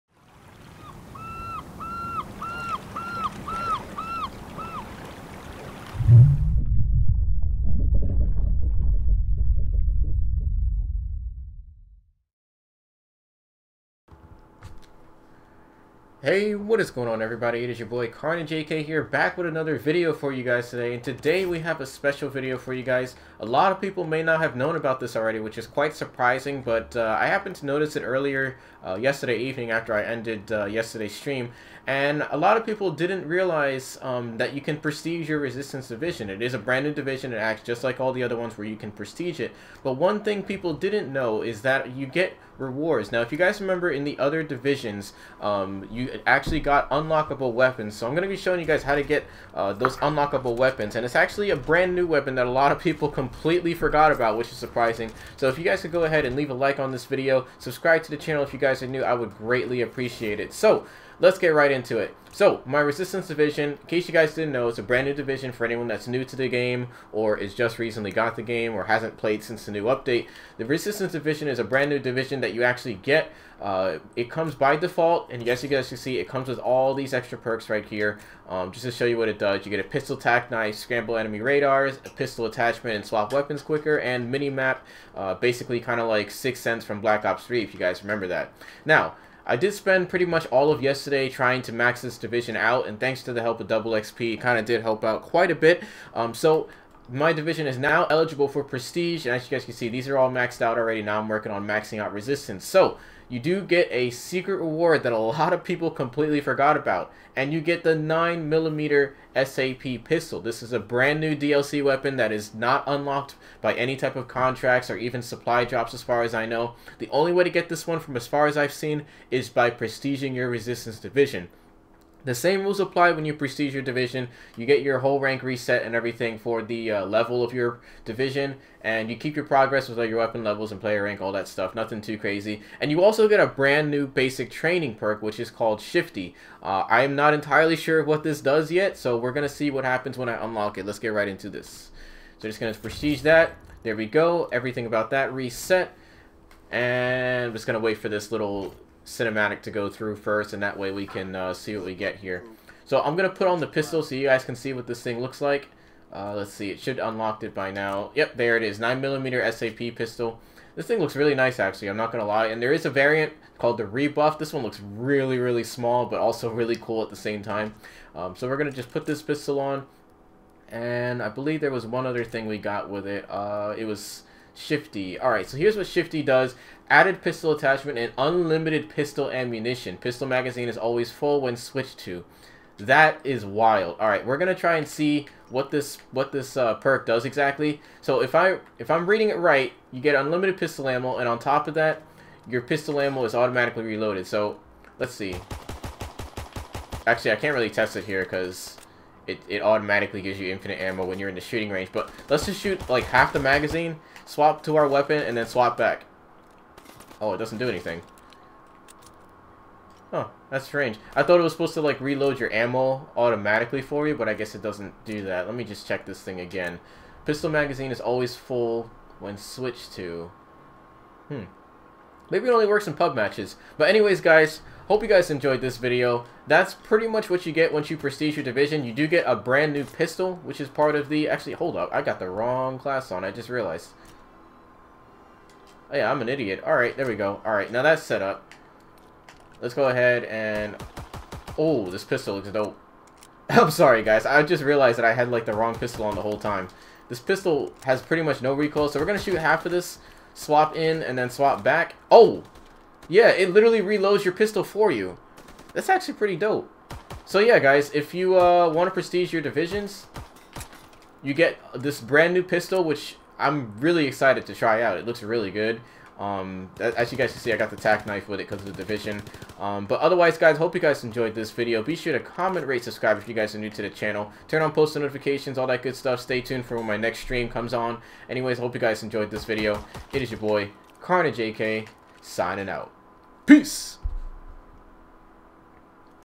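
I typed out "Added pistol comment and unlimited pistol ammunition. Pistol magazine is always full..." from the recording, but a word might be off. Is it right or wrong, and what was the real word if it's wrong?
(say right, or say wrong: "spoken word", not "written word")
wrong: "attachment", not "comment".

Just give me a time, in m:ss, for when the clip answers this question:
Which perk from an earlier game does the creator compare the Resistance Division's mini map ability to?
1:26.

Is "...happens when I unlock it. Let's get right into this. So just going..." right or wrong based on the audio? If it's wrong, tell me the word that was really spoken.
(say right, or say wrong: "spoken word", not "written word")
right.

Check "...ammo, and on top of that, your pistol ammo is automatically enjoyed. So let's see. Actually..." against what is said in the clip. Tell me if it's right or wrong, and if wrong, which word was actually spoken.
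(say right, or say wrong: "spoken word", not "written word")
wrong: "reloaded", not "enjoyed".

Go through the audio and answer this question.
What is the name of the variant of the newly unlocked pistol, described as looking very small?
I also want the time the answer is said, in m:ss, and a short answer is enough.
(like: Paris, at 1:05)
Rebuff, at 2:43.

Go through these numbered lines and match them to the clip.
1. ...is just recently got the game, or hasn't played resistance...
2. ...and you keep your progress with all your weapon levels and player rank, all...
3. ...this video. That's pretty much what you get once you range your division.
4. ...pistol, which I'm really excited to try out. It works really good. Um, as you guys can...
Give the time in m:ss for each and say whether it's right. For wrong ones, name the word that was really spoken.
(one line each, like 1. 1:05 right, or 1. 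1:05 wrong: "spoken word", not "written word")
1. 1:07 wrong: "since", not "resistance"
2. 2:08 right
3. 3:45 wrong: "prestige", not "range"
4. 4:22 wrong: "looks", not "works".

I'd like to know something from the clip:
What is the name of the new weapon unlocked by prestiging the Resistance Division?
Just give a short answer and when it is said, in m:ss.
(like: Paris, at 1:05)
9mm SAP pistol, at 1:47.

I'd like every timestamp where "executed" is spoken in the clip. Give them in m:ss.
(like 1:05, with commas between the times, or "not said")
not said.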